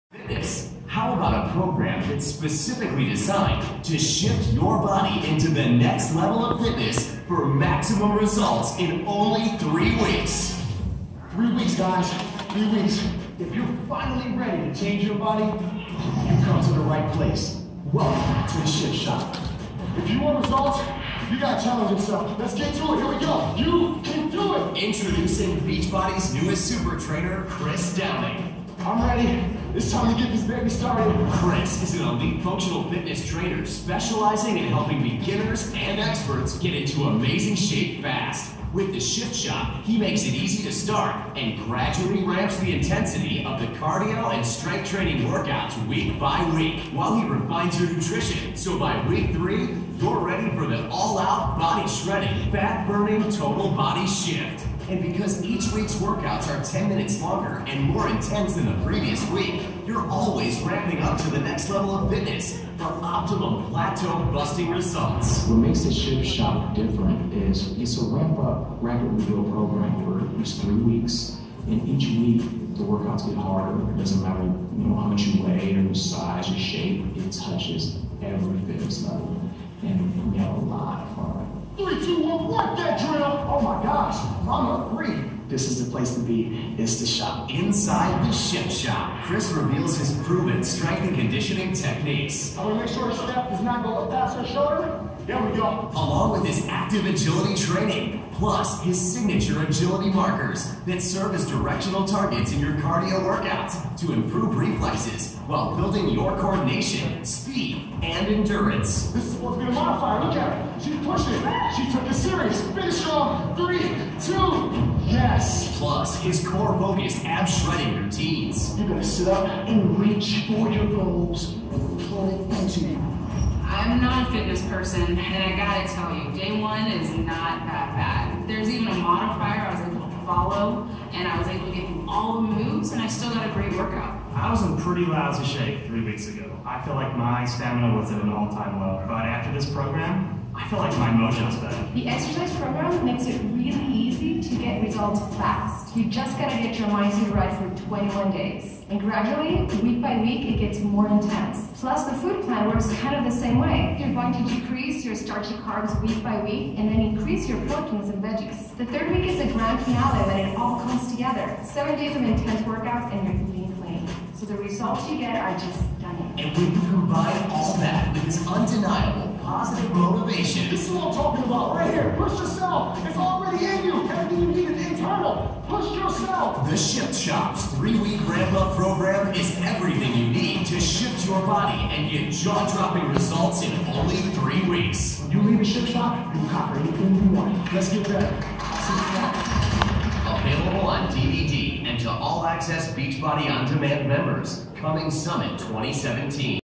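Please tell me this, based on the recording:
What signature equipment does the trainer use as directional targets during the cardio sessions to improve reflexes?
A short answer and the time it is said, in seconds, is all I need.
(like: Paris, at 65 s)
agility markers, at 99 s.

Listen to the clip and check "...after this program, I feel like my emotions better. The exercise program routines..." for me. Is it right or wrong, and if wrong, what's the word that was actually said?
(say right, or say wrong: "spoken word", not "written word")
wrong: "makes", not "routines".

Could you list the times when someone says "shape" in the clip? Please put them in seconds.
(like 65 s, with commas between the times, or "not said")
37 s, 76 s, 135 s.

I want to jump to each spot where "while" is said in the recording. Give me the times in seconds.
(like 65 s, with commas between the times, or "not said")
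46 s, 105 s.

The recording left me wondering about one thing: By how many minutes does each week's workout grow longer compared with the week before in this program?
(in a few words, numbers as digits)
10.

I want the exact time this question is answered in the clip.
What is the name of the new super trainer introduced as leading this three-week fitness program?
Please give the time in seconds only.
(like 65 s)
27 s.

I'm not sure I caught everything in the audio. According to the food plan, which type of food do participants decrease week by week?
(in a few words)
starchy carbs.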